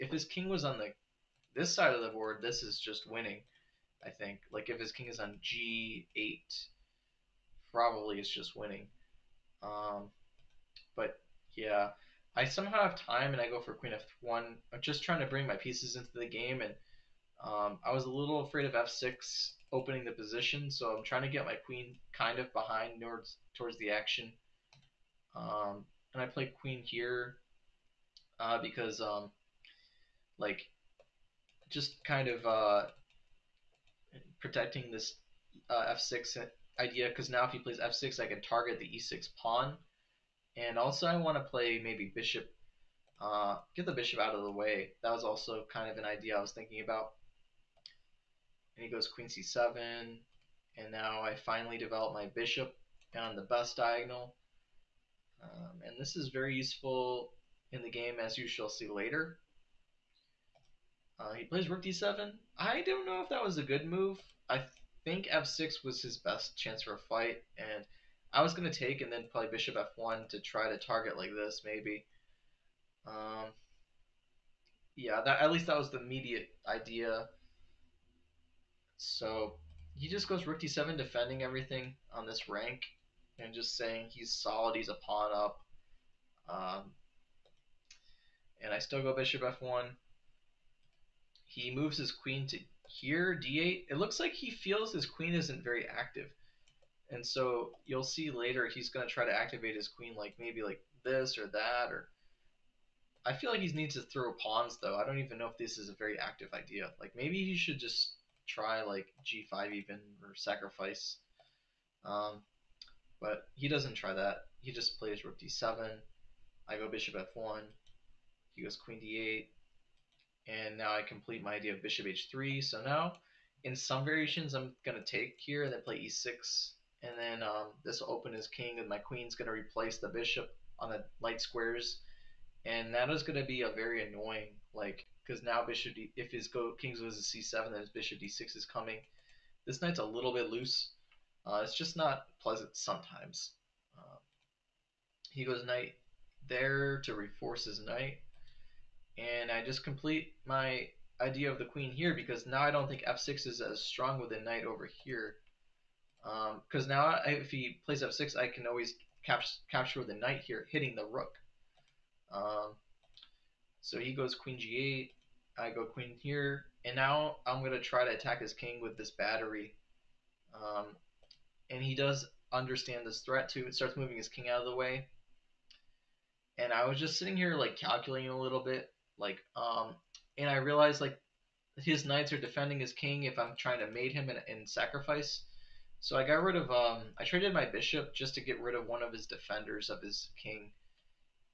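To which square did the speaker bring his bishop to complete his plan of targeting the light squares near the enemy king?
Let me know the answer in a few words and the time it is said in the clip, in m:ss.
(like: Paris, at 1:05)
h3, at 2:01.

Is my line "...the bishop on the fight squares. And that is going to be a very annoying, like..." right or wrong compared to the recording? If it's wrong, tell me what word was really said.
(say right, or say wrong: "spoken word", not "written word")
wrong: "light", not "fight".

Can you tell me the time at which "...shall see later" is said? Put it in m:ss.
0:58.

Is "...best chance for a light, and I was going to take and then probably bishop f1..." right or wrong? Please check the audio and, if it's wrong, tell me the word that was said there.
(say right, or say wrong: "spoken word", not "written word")
wrong: "fight", not "light".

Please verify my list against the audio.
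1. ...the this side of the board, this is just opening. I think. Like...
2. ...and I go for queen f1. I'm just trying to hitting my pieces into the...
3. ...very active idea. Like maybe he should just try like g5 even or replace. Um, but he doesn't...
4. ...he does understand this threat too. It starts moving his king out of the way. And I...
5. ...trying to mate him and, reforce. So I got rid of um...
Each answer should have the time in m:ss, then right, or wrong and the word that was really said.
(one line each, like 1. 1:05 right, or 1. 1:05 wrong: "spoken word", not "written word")
1. 0:00 wrong: "winning", not "opening"
2. 0:13 wrong: "bring", not "hitting"
3. 1:45 wrong: "sacrifice", not "replace"
4. 2:51 right
5. 3:03 wrong: "sacrifice", not "reforce".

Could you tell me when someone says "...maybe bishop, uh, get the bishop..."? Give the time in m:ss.
0:41.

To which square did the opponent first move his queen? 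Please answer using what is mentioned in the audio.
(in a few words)
c7.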